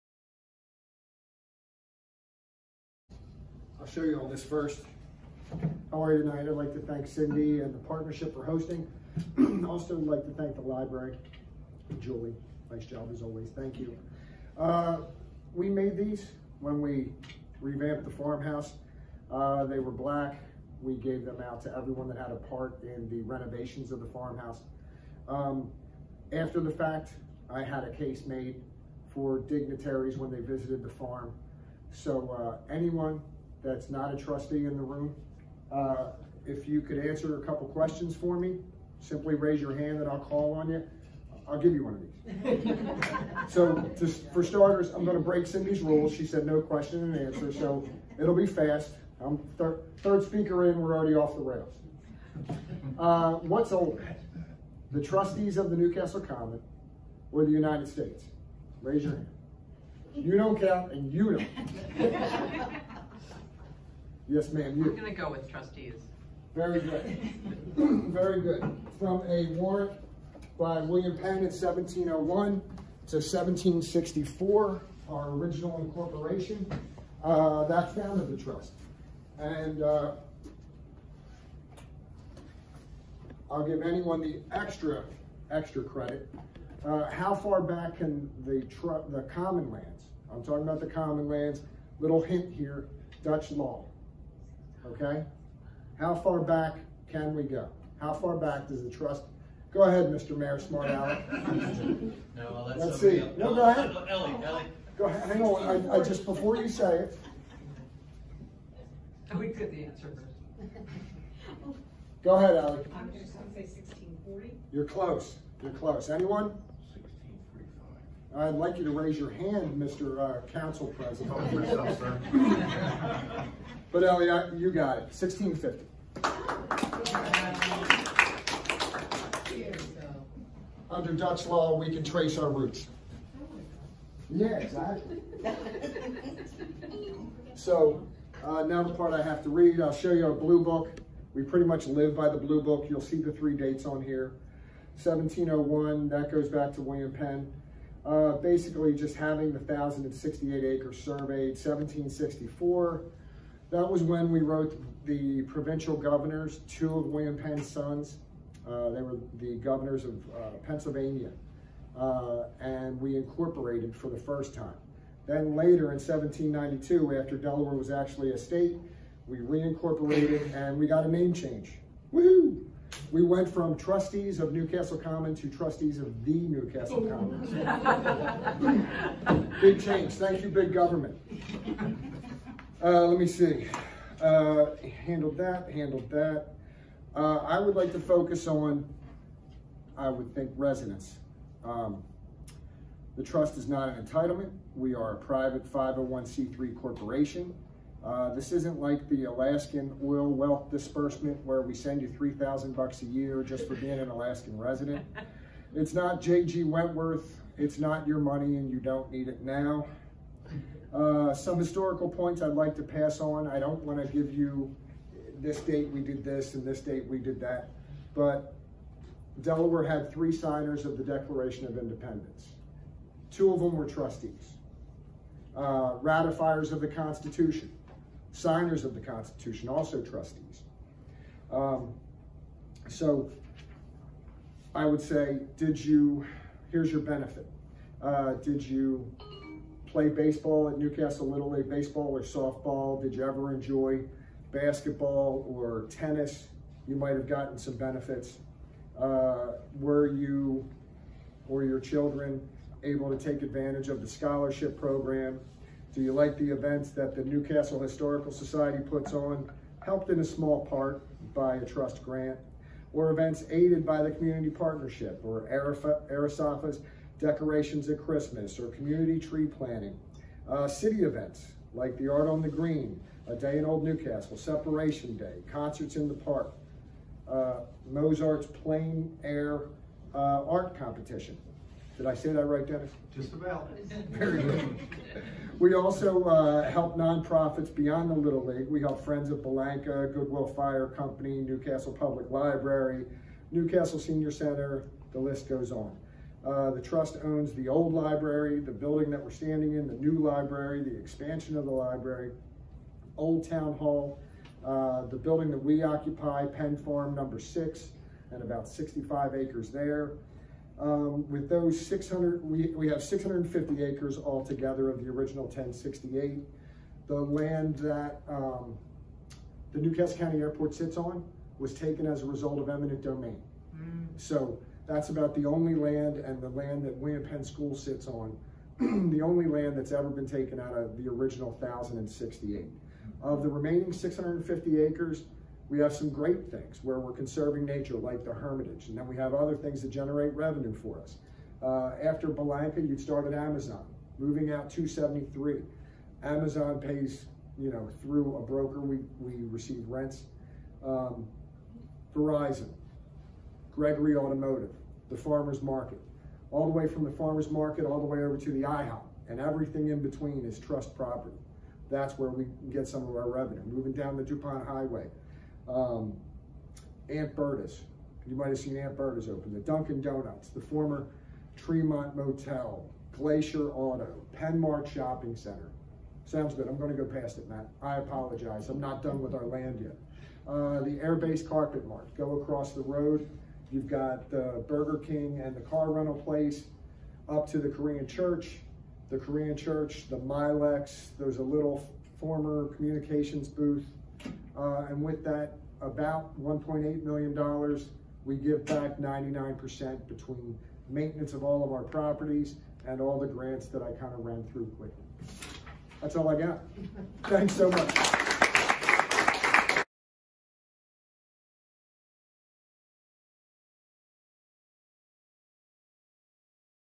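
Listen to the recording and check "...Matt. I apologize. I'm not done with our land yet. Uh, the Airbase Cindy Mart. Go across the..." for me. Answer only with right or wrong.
wrong.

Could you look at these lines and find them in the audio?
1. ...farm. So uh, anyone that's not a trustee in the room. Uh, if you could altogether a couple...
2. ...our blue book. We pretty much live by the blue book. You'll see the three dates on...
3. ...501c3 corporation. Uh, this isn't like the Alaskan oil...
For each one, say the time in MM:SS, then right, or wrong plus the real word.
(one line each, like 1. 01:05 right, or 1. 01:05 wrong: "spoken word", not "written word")
1. 00:30 wrong: "answer", not "altogether"
2. 02:20 right
3. 03:15 right.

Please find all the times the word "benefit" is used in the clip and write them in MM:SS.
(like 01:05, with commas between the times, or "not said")
03:57, 04:07.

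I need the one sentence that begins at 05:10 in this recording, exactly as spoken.
Um, with those 600, we, we have 650 acres altogether of the original 1068.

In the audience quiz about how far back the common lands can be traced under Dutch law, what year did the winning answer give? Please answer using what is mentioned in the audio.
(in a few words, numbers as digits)
1650.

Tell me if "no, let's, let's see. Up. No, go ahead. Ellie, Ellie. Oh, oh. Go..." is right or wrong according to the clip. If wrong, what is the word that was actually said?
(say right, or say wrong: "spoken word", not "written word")
right.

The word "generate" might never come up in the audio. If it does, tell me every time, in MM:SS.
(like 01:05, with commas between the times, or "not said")
05:39.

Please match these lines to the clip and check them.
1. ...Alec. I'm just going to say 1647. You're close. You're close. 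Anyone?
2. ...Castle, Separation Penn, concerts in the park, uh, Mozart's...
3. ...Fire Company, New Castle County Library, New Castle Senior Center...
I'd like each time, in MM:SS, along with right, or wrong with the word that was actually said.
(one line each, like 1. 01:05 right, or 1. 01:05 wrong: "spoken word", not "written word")
1. 01:52 wrong: "1640", not "1647"
2. 04:33 wrong: "Day", not "Penn"
3. 04:50 wrong: "Public", not "County".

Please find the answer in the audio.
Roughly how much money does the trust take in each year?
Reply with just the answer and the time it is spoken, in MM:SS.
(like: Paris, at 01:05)
$1.8 million, at 06:36.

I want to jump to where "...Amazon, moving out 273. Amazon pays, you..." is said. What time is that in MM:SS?
05:43.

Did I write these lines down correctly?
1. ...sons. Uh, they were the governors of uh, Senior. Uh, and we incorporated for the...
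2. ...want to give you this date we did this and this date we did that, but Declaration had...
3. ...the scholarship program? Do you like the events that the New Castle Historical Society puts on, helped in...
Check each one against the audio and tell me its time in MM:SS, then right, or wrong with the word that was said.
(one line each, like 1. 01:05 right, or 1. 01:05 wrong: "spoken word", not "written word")
1. 02:37 wrong: "Pennsylvania", not "Senior"
2. 03:33 wrong: "Delaware", not "Declaration"
3. 04:14 right.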